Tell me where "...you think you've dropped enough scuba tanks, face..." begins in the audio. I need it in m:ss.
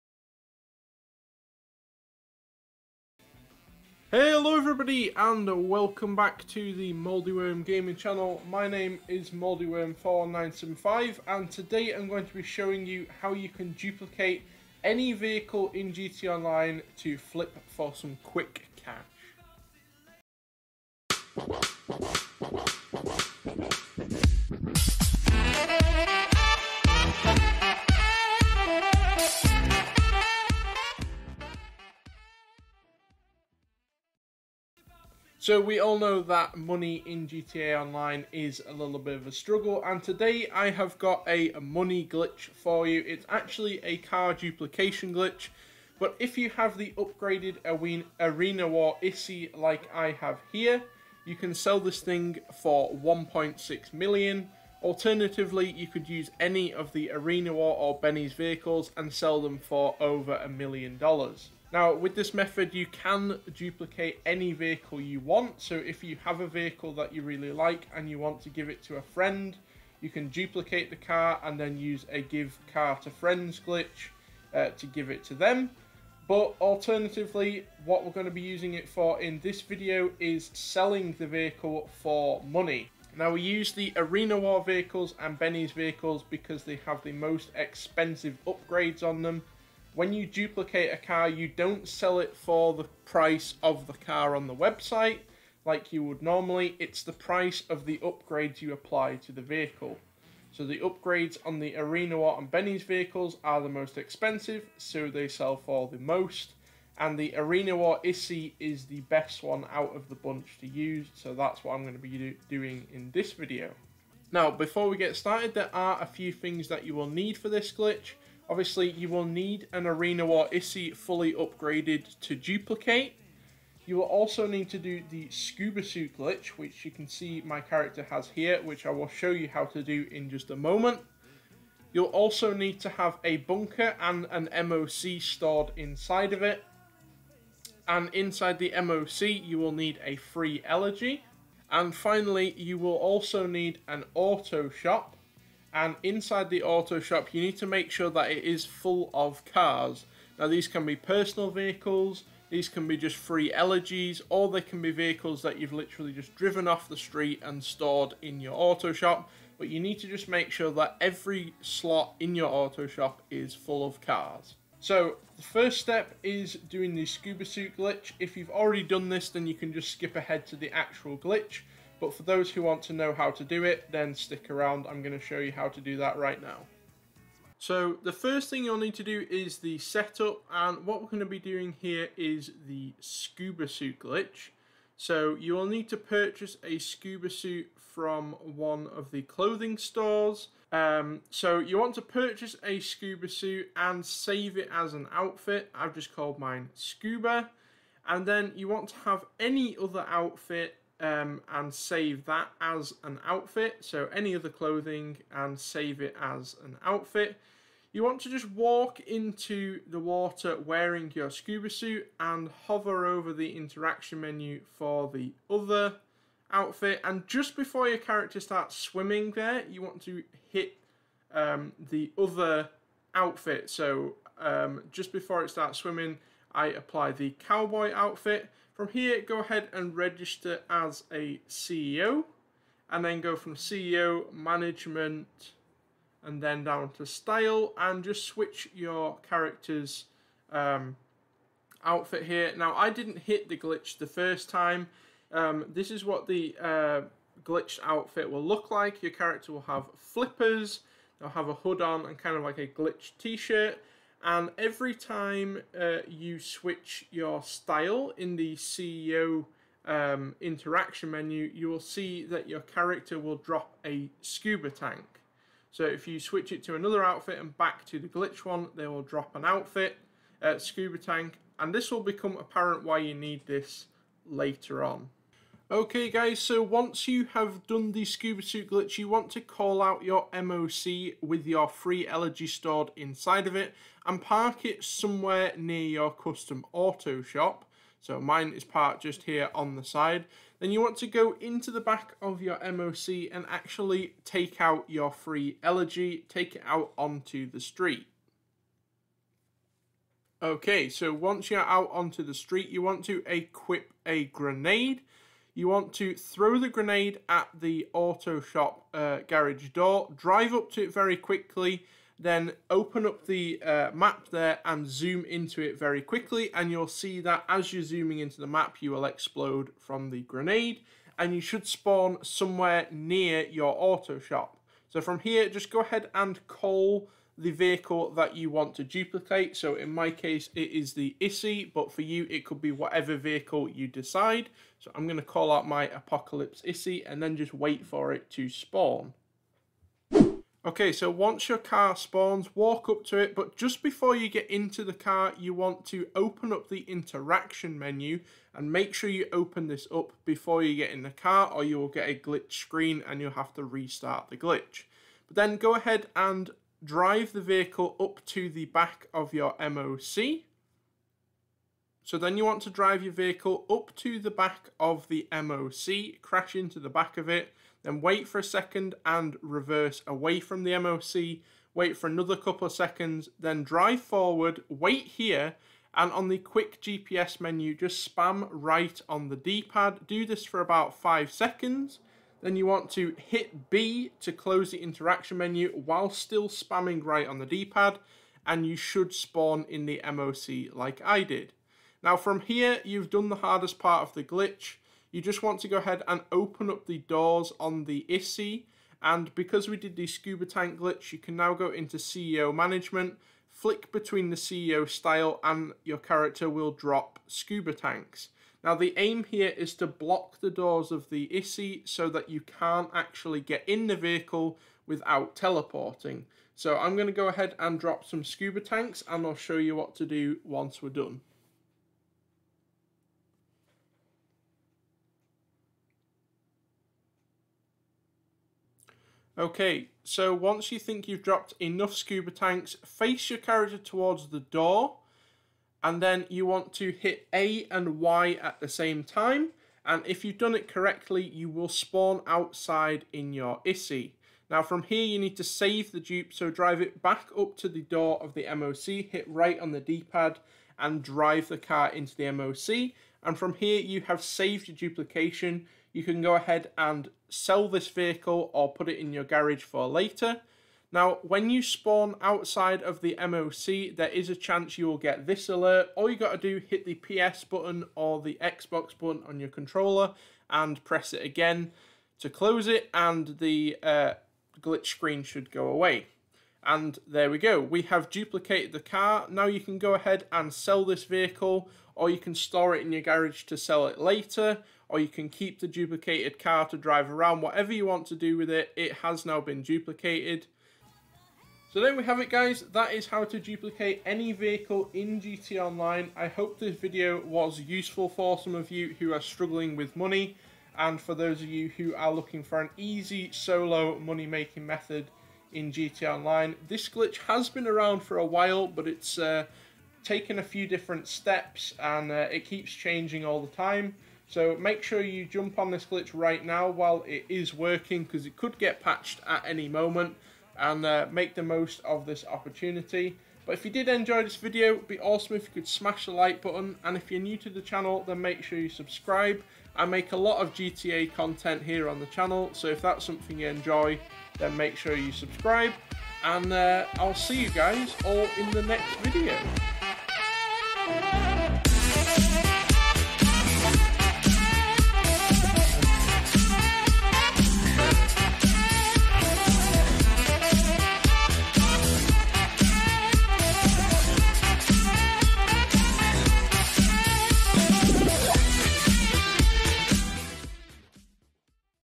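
7:10.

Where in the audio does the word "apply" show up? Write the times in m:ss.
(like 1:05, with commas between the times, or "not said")
1:38, 3:46.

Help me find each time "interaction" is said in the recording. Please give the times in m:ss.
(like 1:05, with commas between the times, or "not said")
3:33, 4:20, 5:46, 6:24.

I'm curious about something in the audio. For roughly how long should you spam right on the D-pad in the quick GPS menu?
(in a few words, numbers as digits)
5 seconds.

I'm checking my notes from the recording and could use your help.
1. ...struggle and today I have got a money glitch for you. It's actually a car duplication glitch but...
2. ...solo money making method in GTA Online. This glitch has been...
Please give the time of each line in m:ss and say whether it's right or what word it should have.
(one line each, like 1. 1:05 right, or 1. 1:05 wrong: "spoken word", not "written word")
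1. 0:39 right
2. 8:23 right.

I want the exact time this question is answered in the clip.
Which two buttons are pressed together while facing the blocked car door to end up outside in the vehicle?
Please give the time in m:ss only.
7:17.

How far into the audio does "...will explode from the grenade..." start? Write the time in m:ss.
5:18.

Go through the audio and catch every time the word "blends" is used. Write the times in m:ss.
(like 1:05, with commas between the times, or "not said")
not said.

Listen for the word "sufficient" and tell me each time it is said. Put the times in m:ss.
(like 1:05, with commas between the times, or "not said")
not said.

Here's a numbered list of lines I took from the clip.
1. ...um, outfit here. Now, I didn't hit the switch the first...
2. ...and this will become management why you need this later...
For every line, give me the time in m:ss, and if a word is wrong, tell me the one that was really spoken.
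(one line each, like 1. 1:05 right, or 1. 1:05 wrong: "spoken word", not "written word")
1. 4:00 wrong: "glitch", not "switch"
2. 4:31 wrong: "apparent", not "management".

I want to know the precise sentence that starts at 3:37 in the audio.
And just before your character starts swimming there, you want to hit um, the other outfit.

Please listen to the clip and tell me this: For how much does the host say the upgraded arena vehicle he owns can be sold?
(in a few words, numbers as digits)
1.6 million.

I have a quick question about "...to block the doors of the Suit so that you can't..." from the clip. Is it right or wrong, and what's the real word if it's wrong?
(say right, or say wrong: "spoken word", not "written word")
wrong: "Issi", not "Suit".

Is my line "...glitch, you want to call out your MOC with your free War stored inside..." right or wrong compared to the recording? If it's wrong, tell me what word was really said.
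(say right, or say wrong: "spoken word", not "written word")
wrong: "Elegy", not "War".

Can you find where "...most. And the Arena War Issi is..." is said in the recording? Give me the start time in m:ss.
1:45.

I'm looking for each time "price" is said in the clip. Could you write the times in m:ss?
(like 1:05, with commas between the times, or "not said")
1:33, 1:37.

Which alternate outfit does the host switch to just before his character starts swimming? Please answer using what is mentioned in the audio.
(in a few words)
cowboy outfit.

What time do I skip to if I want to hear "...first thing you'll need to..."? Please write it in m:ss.
2:58.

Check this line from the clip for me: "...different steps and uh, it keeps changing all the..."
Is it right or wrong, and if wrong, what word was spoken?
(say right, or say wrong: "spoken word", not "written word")
right.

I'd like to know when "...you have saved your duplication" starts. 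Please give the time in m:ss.
7:33.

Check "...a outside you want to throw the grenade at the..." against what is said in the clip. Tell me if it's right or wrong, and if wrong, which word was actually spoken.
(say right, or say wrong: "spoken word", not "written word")
wrong: "grenade", not "outside".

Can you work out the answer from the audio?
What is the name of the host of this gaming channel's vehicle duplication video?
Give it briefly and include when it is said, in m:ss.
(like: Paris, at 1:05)
Moldyworm41975, at 0:09.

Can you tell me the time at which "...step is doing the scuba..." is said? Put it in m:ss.
2:45.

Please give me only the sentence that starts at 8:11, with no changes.
So there we have it guys, that is how to duplicate any vehicle in GTA Online.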